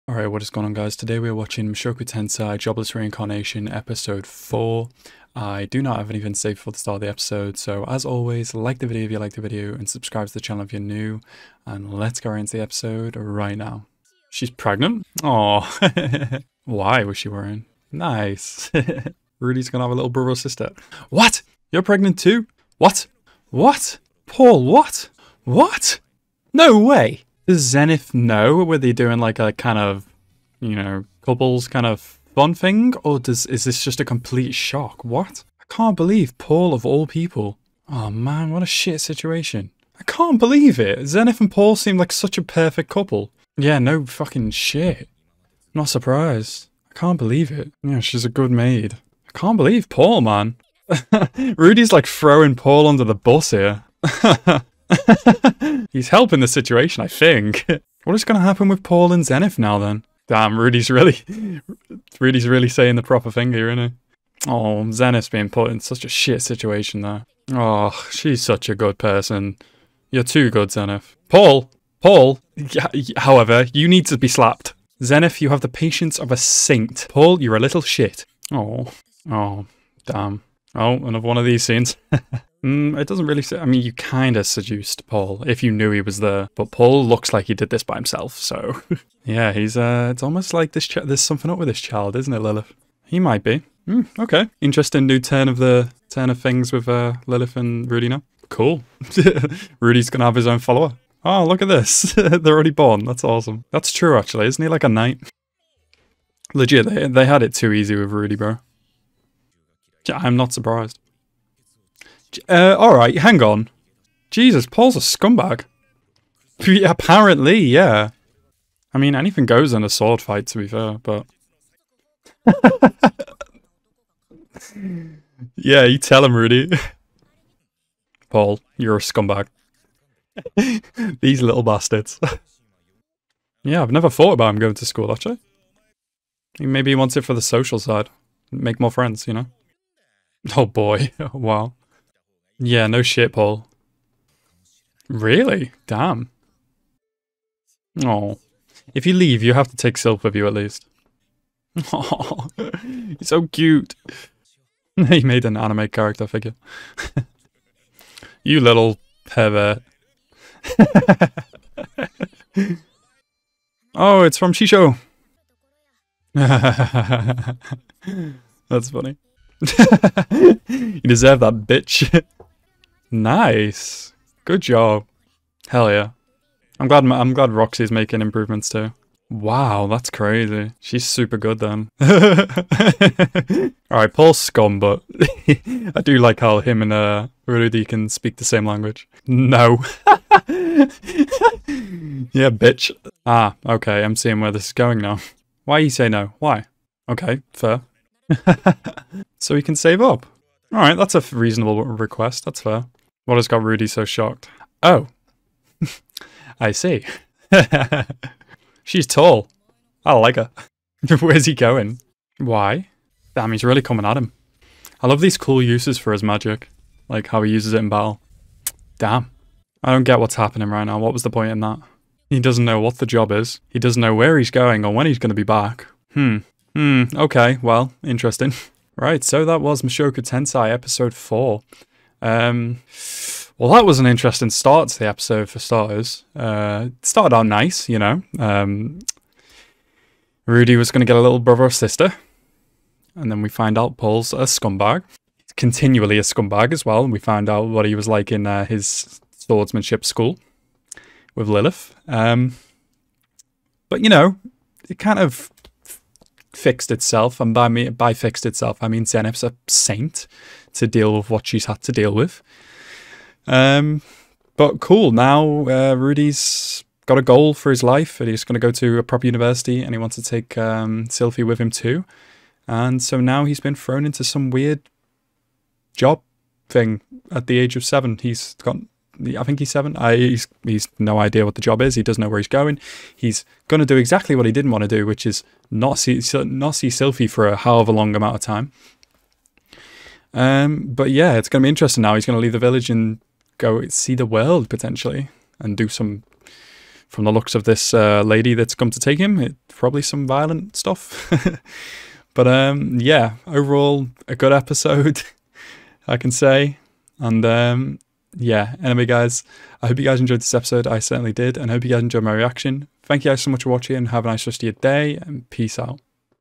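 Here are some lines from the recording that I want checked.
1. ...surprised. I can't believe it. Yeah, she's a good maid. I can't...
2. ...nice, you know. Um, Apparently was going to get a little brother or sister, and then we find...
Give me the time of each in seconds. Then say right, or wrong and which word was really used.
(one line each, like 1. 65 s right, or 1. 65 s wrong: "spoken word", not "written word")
1. 45 s right
2. 237 s wrong: "Rudy", not "Apparently".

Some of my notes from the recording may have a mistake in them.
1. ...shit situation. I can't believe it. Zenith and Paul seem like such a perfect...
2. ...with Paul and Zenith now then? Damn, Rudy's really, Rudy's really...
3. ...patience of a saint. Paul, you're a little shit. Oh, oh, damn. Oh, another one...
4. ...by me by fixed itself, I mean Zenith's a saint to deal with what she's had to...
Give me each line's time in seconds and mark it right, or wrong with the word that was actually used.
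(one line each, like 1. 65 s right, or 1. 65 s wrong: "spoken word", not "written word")
1. 38 s right
2. 58 s right
3. 75 s right
4. 257 s right.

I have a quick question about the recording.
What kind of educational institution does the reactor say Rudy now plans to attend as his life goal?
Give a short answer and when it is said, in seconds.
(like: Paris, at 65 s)
a proper university, at 268 s.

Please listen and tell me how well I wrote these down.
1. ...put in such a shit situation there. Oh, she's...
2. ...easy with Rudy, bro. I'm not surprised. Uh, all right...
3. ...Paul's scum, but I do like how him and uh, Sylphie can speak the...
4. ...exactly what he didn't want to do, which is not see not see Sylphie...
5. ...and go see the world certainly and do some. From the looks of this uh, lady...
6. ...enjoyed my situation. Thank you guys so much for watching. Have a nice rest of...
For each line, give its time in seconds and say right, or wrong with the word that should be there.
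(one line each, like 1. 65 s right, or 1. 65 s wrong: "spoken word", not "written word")
1. 65 s right
2. 107 s right
3. 184 s wrong: "Rudy", not "Sylphie"
4. 283 s right
5. 292 s wrong: "potentially", not "certainly"
6. 312 s wrong: "reaction", not "situation".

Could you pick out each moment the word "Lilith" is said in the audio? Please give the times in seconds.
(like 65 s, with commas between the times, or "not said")
92 s, 97 s, 251 s.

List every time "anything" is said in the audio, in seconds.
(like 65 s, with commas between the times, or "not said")
6 s, 119 s.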